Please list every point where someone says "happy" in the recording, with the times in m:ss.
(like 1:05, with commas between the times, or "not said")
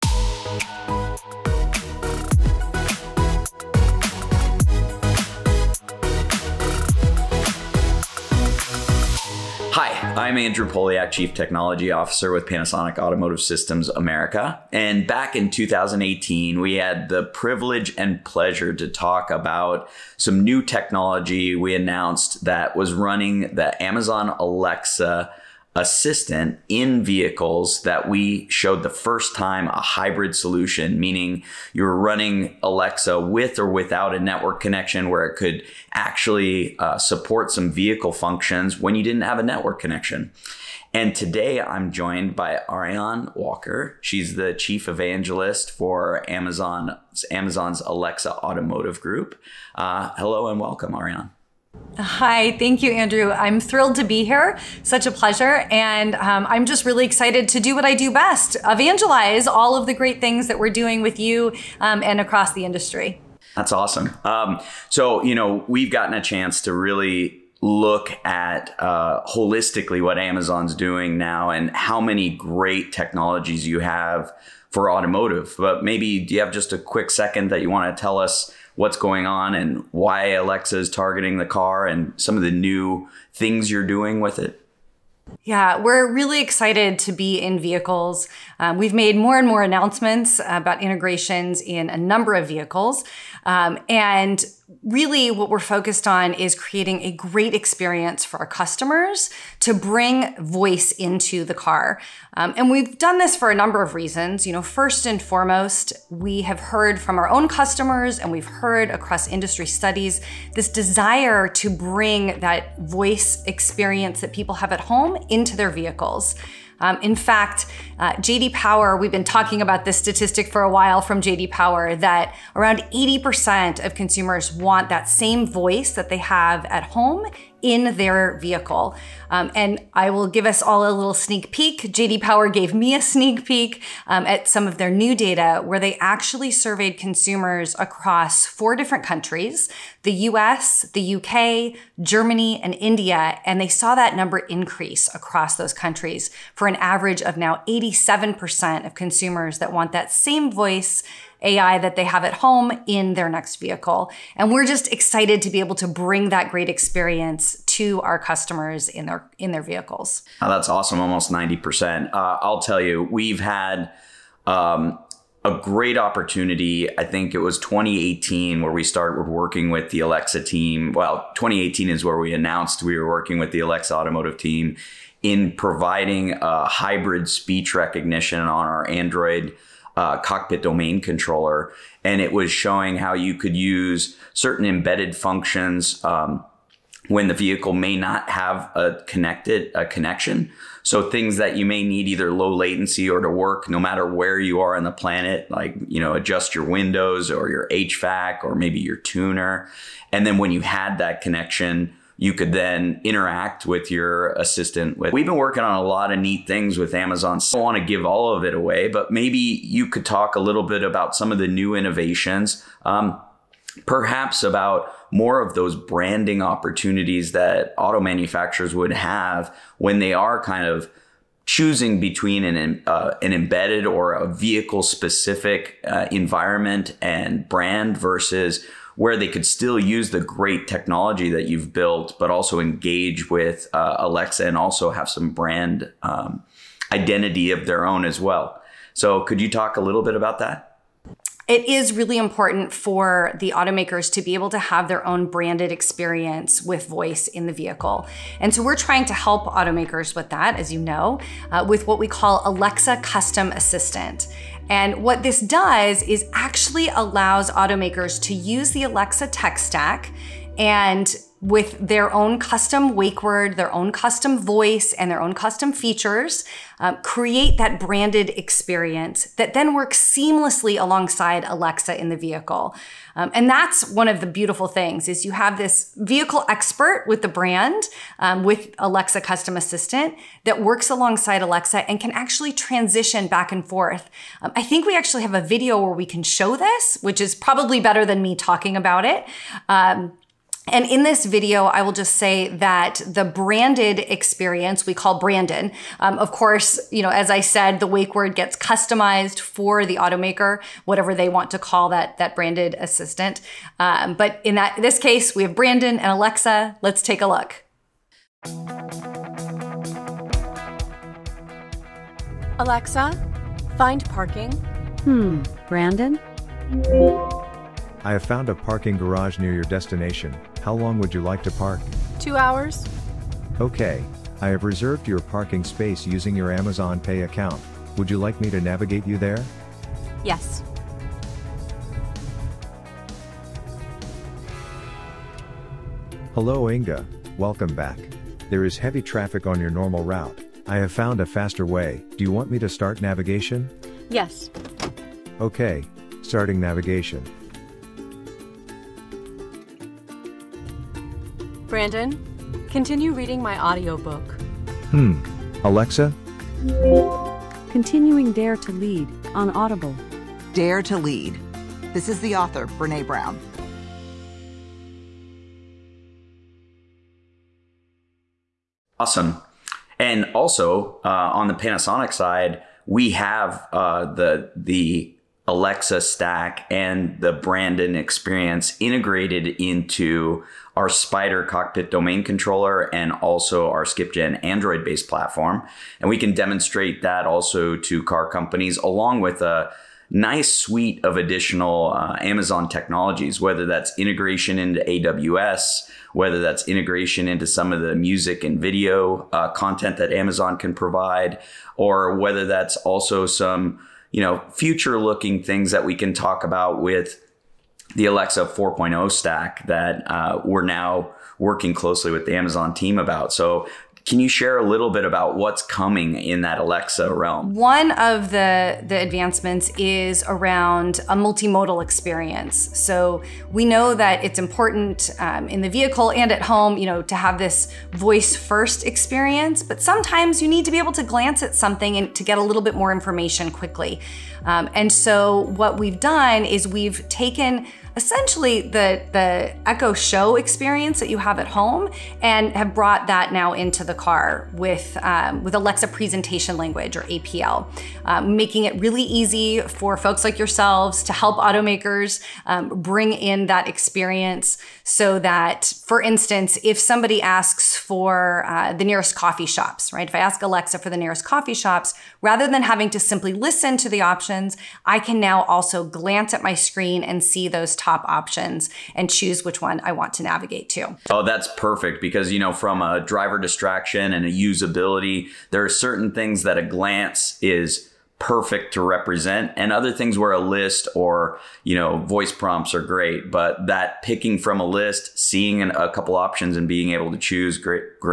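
not said.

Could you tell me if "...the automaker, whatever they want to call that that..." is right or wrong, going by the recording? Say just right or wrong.
right.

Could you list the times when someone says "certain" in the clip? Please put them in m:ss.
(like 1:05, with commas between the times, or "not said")
3:04, 7:55.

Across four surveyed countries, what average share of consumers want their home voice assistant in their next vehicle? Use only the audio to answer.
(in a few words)
87%.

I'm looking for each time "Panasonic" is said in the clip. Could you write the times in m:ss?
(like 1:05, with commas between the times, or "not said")
0:12, 6:11.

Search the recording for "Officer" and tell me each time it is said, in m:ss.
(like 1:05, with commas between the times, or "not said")
0:11.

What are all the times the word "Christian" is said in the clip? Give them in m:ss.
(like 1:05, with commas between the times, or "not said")
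not said.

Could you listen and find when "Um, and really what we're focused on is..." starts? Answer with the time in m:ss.
1:33.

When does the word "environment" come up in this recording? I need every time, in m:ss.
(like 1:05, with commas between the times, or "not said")
3:46.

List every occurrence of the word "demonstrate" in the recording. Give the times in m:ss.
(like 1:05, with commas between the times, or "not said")
6:26.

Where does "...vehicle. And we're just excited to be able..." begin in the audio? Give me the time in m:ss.
2:33.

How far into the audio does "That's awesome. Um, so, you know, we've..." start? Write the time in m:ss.
1:03.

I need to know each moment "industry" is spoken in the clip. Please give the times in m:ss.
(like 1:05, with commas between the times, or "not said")
1:02, 1:49.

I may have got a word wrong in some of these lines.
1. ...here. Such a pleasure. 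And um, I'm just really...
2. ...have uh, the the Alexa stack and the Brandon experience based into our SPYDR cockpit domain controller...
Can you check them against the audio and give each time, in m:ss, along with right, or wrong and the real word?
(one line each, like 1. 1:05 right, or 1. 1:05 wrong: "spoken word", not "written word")
1. 0:54 right
2. 6:13 wrong: "integrated", not "based".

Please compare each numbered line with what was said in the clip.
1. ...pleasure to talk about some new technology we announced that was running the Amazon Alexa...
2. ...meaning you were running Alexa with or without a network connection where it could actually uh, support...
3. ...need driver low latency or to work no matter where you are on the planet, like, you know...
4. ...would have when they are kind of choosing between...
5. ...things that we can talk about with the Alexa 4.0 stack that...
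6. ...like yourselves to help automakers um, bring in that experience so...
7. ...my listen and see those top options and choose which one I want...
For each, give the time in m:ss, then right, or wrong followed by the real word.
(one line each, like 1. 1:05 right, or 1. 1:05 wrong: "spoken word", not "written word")
1. 0:18 right
2. 0:30 right
3. 3:11 wrong: "either", not "driver"
4. 3:38 right
5. 6:45 right
6. 7:30 right
7. 7:46 wrong: "screen", not "listen".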